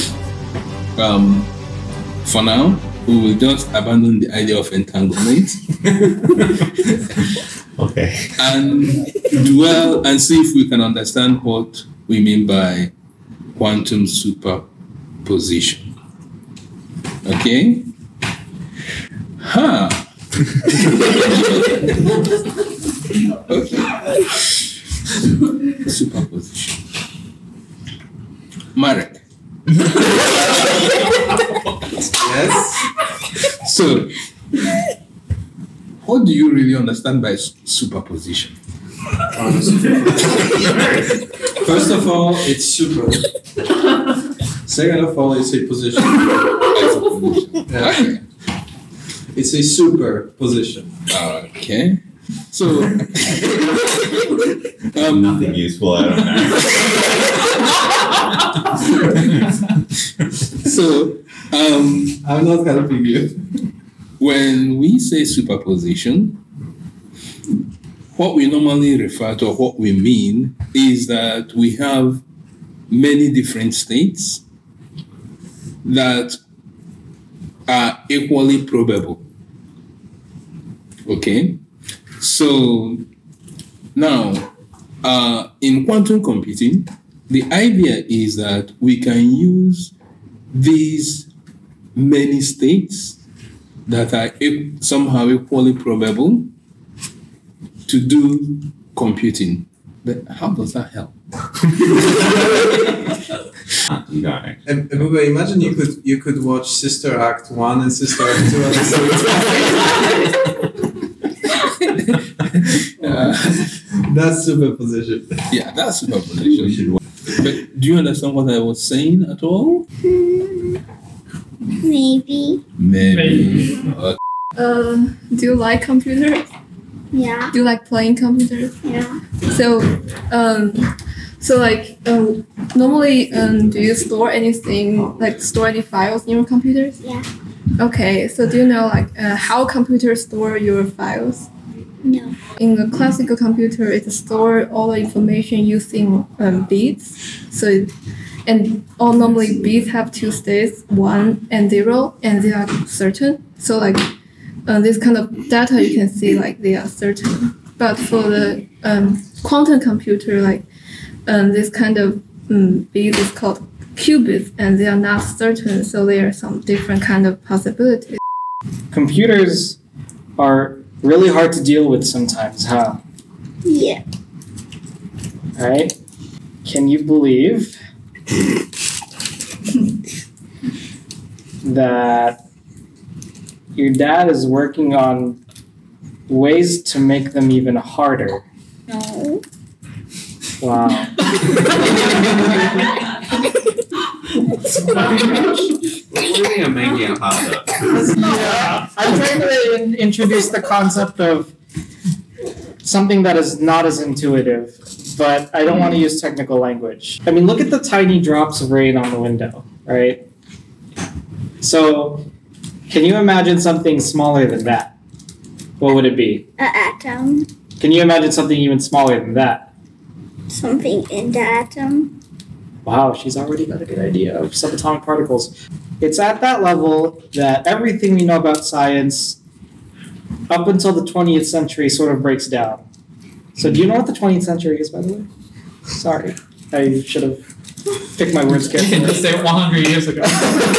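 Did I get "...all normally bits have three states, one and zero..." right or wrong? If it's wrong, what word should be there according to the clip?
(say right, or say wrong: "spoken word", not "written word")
wrong: "two", not "three".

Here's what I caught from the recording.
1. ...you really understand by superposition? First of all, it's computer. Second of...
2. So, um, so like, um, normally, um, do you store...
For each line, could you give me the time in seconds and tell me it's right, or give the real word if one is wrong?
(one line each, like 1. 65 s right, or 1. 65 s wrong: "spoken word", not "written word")
1. 36 s wrong: "super", not "computer"
2. 129 s right.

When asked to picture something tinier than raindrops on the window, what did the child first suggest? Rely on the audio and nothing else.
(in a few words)
An atom.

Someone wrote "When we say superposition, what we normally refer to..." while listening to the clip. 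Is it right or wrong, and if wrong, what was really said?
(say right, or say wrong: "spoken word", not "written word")
right.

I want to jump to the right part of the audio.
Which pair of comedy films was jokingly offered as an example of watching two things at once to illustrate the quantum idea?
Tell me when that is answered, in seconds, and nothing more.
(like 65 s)
106 s.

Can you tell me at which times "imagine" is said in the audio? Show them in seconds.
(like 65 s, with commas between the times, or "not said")
104 s, 213 s, 218 s.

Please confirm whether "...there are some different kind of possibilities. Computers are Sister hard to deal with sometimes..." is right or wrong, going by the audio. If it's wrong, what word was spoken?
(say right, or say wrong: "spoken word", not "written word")
wrong: "Really", not "Sister".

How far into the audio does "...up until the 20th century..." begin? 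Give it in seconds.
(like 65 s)
230 s.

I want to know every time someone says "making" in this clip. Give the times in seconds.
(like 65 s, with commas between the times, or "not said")
196 s.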